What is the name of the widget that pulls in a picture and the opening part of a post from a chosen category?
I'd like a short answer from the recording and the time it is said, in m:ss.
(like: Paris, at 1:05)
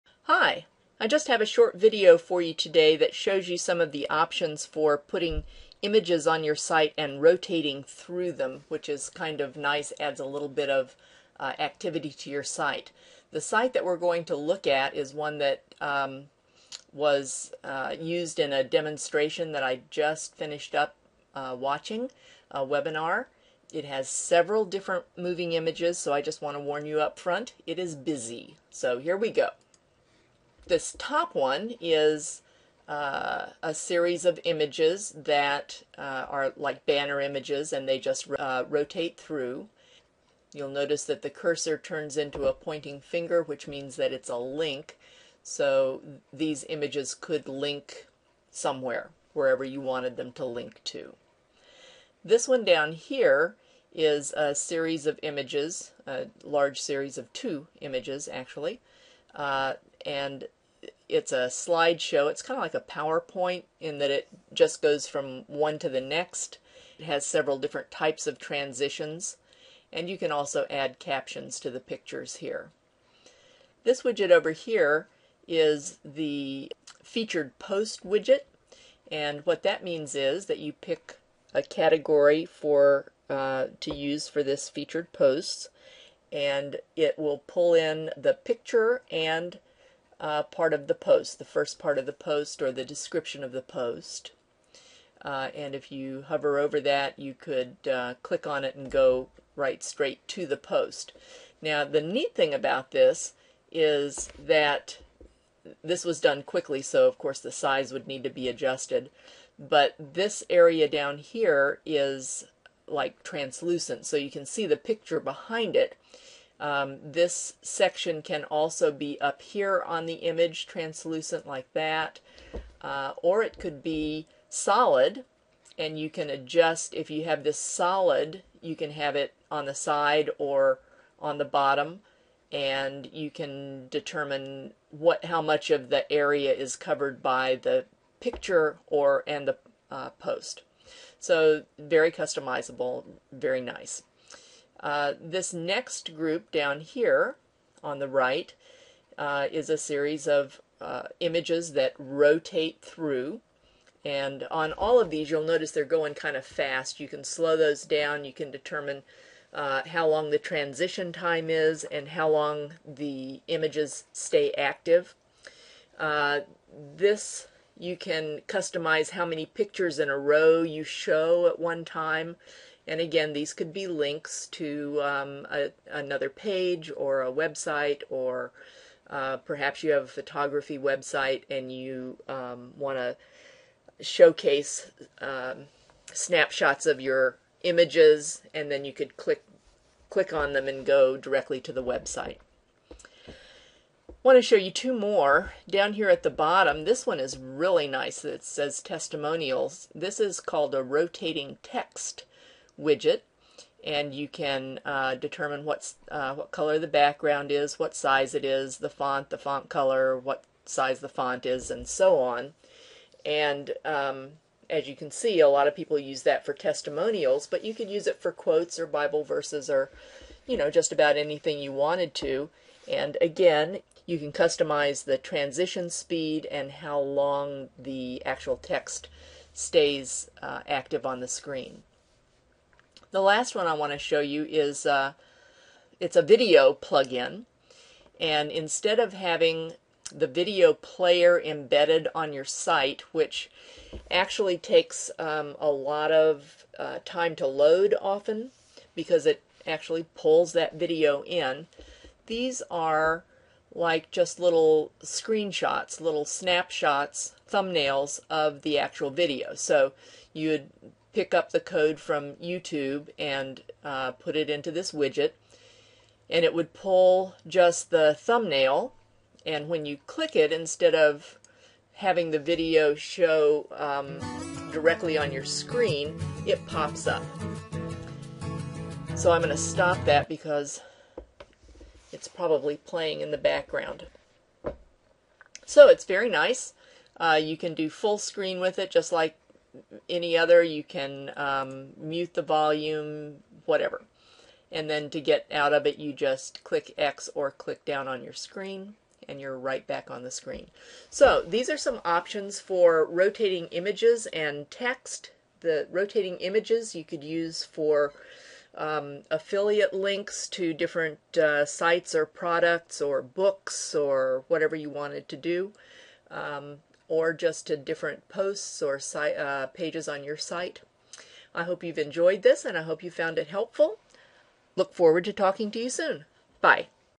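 featured post widget, at 1:17.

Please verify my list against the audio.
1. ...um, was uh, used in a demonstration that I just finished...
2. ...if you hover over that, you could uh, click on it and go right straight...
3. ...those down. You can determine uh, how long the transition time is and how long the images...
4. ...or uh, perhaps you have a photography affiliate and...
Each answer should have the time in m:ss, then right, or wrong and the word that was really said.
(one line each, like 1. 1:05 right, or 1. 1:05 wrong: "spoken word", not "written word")
1. 0:15 right
2. 1:35 right
3. 2:37 right
4. 2:58 wrong: "website", not "affiliate".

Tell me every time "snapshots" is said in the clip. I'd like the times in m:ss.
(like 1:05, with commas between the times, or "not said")
3:06, 4:16.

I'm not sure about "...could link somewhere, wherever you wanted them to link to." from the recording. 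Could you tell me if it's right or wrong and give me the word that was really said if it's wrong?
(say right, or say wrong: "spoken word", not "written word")
right.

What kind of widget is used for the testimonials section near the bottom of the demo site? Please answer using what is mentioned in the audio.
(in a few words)
rotating text widget.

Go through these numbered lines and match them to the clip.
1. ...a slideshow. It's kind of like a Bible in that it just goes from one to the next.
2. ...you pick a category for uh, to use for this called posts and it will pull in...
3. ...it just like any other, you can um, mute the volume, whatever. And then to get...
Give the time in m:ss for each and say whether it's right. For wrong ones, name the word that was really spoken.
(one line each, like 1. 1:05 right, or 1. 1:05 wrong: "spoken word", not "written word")
1. 1:01 wrong: "PowerPoint", not "Bible"
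2. 1:20 wrong: "featured", not "called"
3. 4:48 right.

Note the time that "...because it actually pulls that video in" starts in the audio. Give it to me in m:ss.
4:08.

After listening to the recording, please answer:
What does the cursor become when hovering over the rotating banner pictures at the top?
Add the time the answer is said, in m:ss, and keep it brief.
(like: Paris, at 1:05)
pointing finger, at 0:42.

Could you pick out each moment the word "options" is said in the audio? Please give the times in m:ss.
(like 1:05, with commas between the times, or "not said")
0:04, 5:02.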